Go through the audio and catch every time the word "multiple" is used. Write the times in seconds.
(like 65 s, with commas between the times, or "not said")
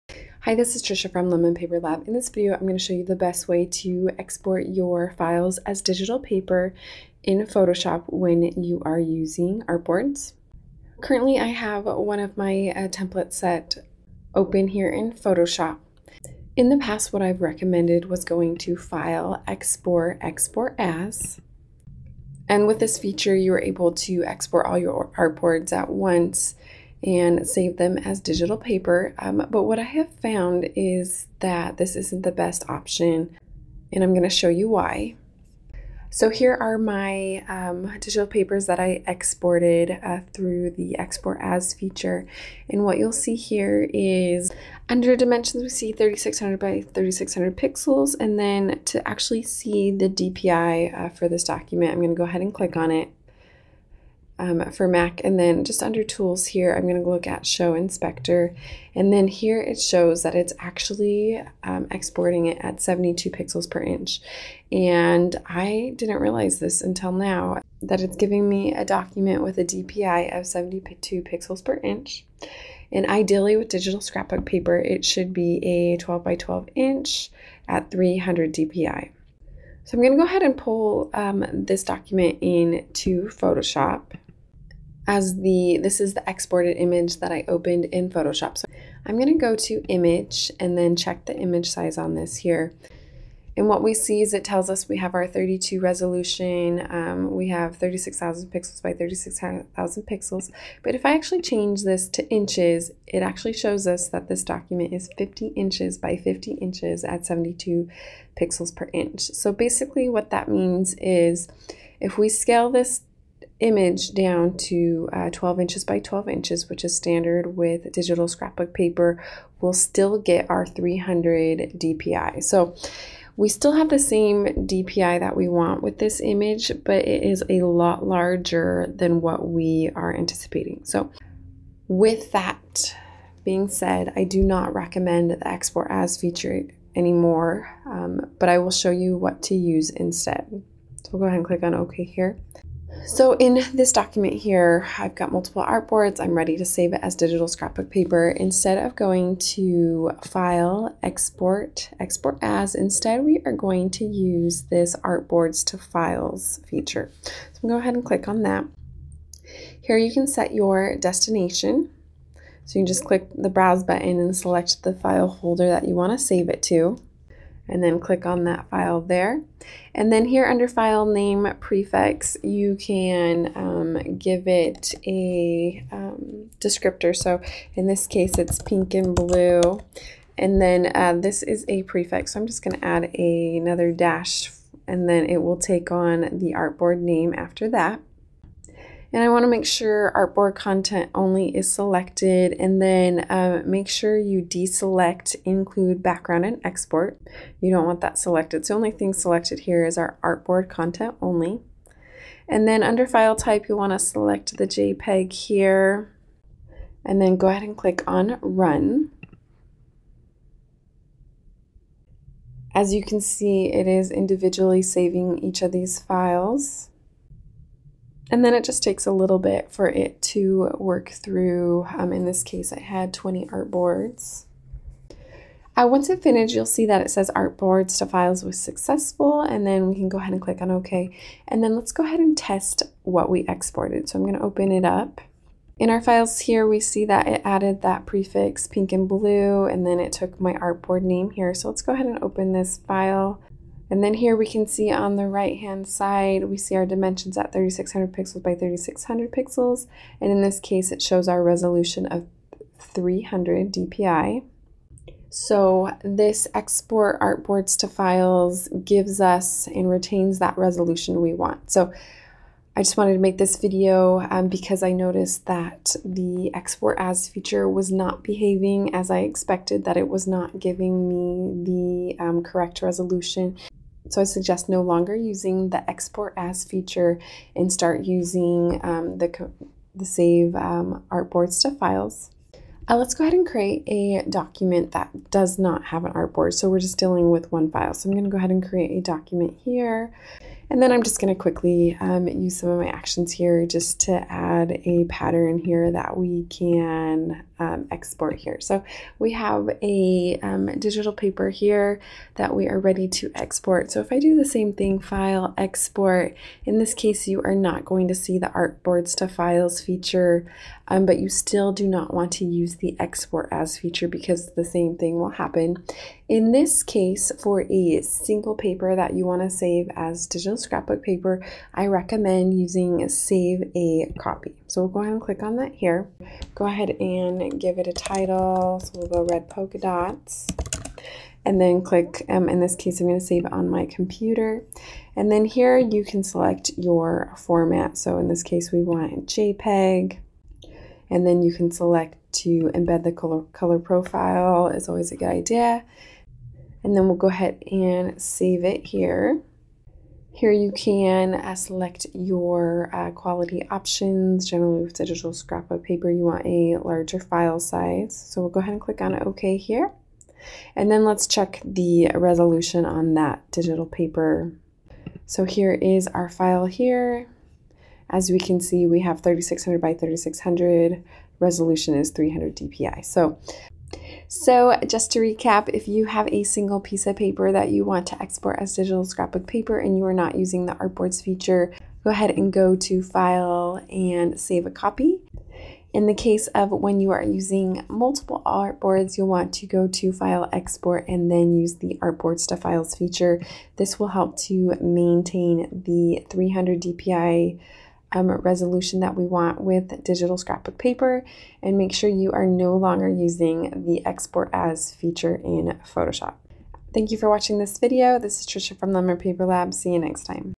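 145 s, 387 s.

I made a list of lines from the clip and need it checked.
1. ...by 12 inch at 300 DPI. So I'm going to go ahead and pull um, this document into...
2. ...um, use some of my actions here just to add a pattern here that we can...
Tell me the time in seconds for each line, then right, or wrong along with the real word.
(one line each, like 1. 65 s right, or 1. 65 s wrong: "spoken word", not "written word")
1. 76 s right
2. 291 s right.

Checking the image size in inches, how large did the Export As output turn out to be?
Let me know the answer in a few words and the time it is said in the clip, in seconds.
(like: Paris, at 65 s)
50 inches by 50 inches, at 105 s.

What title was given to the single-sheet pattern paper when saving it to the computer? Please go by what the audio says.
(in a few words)
red polka dots.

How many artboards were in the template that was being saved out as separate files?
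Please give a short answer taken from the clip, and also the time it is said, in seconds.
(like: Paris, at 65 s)
20, at 223 s.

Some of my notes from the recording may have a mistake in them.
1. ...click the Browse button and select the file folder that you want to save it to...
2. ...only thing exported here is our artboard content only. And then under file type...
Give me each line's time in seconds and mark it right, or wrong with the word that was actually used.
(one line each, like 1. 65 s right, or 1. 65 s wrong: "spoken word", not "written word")
1. 163 s right
2. 198 s wrong: "selected", not "exported".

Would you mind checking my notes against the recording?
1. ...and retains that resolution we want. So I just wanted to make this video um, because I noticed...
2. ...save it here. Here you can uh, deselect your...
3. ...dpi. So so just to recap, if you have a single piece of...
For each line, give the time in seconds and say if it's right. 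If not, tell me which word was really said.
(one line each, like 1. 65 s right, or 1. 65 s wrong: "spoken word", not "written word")
1. 259 s right
2. 348 s wrong: "select", not "deselect"
3. 372 s right.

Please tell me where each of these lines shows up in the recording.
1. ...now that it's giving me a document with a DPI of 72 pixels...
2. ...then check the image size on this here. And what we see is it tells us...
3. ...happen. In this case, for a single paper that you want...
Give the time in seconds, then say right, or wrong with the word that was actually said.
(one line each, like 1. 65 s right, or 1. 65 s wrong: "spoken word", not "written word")
1. 67 s right
2. 90 s right
3. 315 s right.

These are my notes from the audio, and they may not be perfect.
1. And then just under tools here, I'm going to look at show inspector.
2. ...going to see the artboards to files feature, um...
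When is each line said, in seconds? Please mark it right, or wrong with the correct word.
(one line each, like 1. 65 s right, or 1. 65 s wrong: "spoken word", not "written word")
1. 55 s right
2. 307 s right.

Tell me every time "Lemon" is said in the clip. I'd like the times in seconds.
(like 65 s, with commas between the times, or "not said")
1 s, 408 s.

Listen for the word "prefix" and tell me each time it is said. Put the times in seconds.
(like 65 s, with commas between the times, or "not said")
171 s, 181 s, 238 s.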